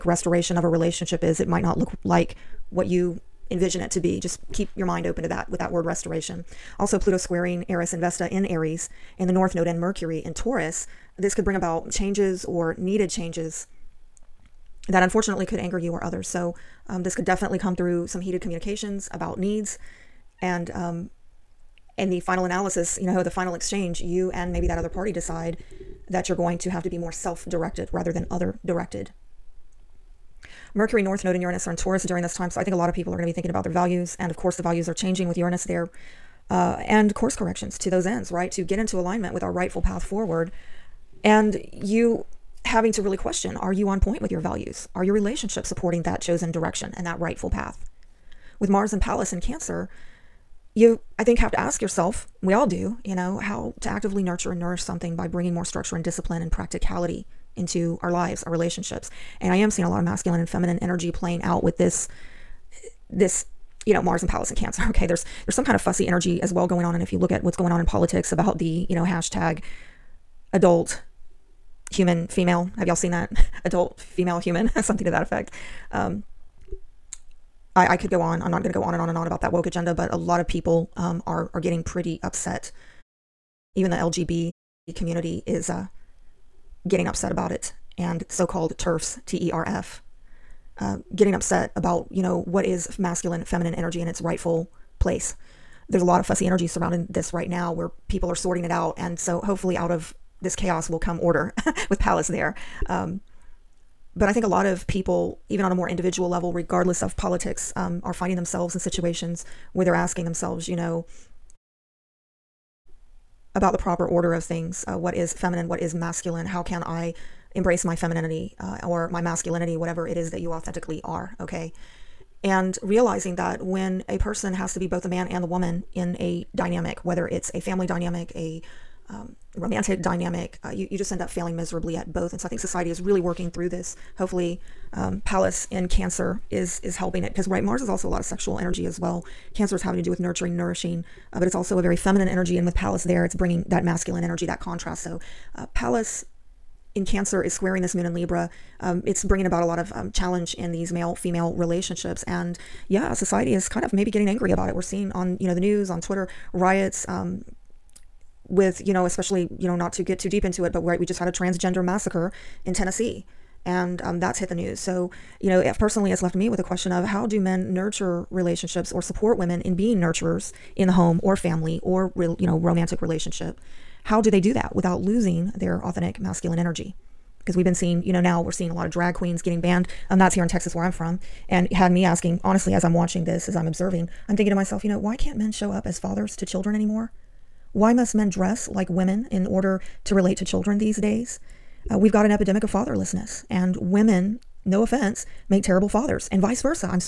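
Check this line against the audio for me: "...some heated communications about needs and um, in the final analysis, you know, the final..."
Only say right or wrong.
right.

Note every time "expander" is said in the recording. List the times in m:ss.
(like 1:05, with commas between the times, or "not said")
not said.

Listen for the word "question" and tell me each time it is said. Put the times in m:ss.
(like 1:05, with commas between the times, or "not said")
0:43, 2:46.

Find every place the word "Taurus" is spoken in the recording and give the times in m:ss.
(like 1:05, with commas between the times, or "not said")
0:10, 0:31.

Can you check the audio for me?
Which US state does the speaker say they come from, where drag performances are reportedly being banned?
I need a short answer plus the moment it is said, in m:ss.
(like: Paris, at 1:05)
Texas, at 3:00.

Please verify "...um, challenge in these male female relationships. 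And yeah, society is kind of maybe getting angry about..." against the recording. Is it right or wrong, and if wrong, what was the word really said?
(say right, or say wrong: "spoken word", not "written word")
right.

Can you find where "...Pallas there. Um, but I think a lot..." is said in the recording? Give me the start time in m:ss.
1:41.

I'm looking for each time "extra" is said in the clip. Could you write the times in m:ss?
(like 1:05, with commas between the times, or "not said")
not said.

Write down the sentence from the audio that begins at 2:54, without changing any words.
How do they do that without losing their authentic masculine energy?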